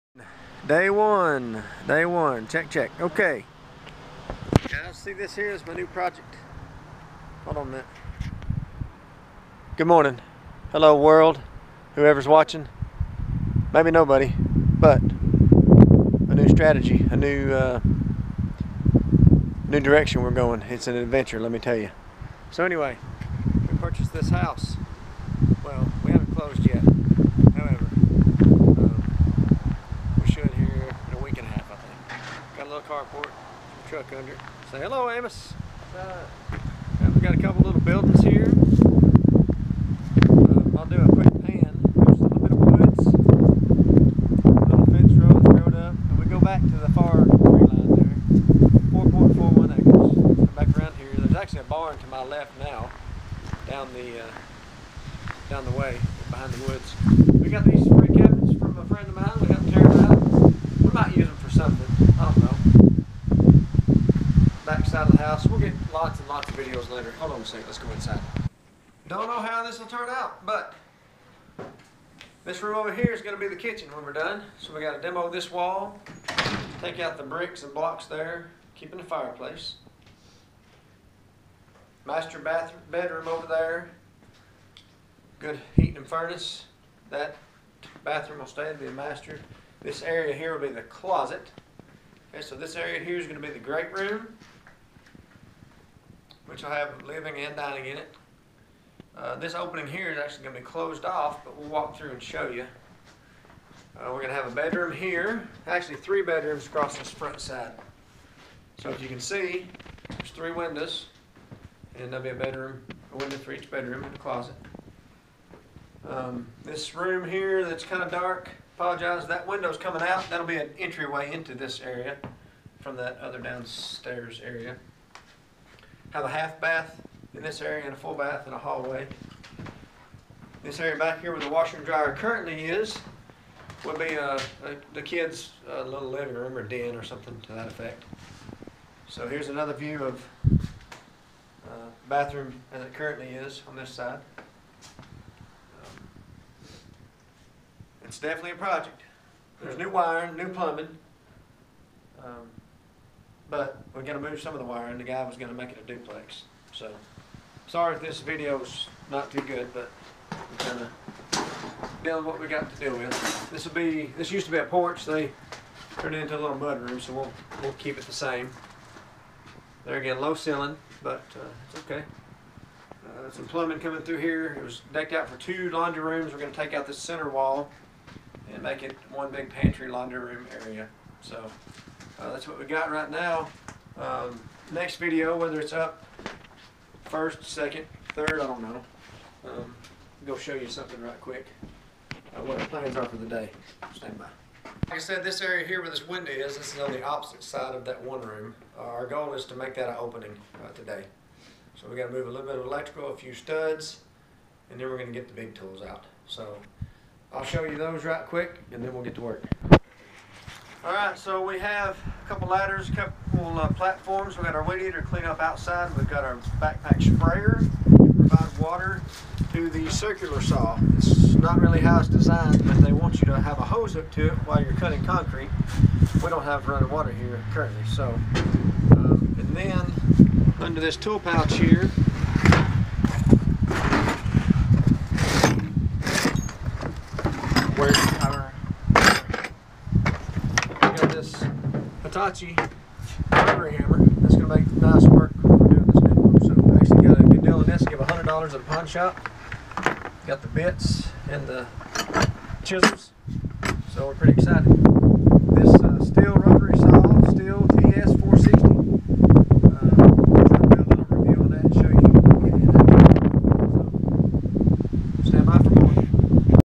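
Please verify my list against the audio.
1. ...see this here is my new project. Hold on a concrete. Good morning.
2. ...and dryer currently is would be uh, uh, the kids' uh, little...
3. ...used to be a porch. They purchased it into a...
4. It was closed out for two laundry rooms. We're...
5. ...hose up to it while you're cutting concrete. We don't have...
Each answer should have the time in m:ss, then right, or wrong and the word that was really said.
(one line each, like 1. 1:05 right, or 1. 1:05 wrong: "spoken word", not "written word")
1. 0:04 wrong: "minute", not "concrete"
2. 2:11 right
3. 2:44 wrong: "turned", not "purchased"
4. 2:54 wrong: "decked", not "closed"
5. 3:43 right.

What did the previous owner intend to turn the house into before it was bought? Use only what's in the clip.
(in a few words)
duplex.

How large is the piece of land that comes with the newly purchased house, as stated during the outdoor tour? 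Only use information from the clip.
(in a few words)
4.41 acres.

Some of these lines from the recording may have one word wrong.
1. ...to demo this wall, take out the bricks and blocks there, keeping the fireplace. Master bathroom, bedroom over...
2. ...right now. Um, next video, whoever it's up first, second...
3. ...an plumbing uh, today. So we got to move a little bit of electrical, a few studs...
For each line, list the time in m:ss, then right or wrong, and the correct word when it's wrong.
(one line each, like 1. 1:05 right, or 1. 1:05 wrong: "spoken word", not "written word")
1. 1:14 right
2. 3:02 wrong: "whether", not "whoever"
3. 3:19 wrong: "opening", not "plumbing".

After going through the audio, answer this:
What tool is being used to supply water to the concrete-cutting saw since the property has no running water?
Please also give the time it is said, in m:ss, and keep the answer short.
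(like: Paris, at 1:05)
backpack sprayer, at 3:36.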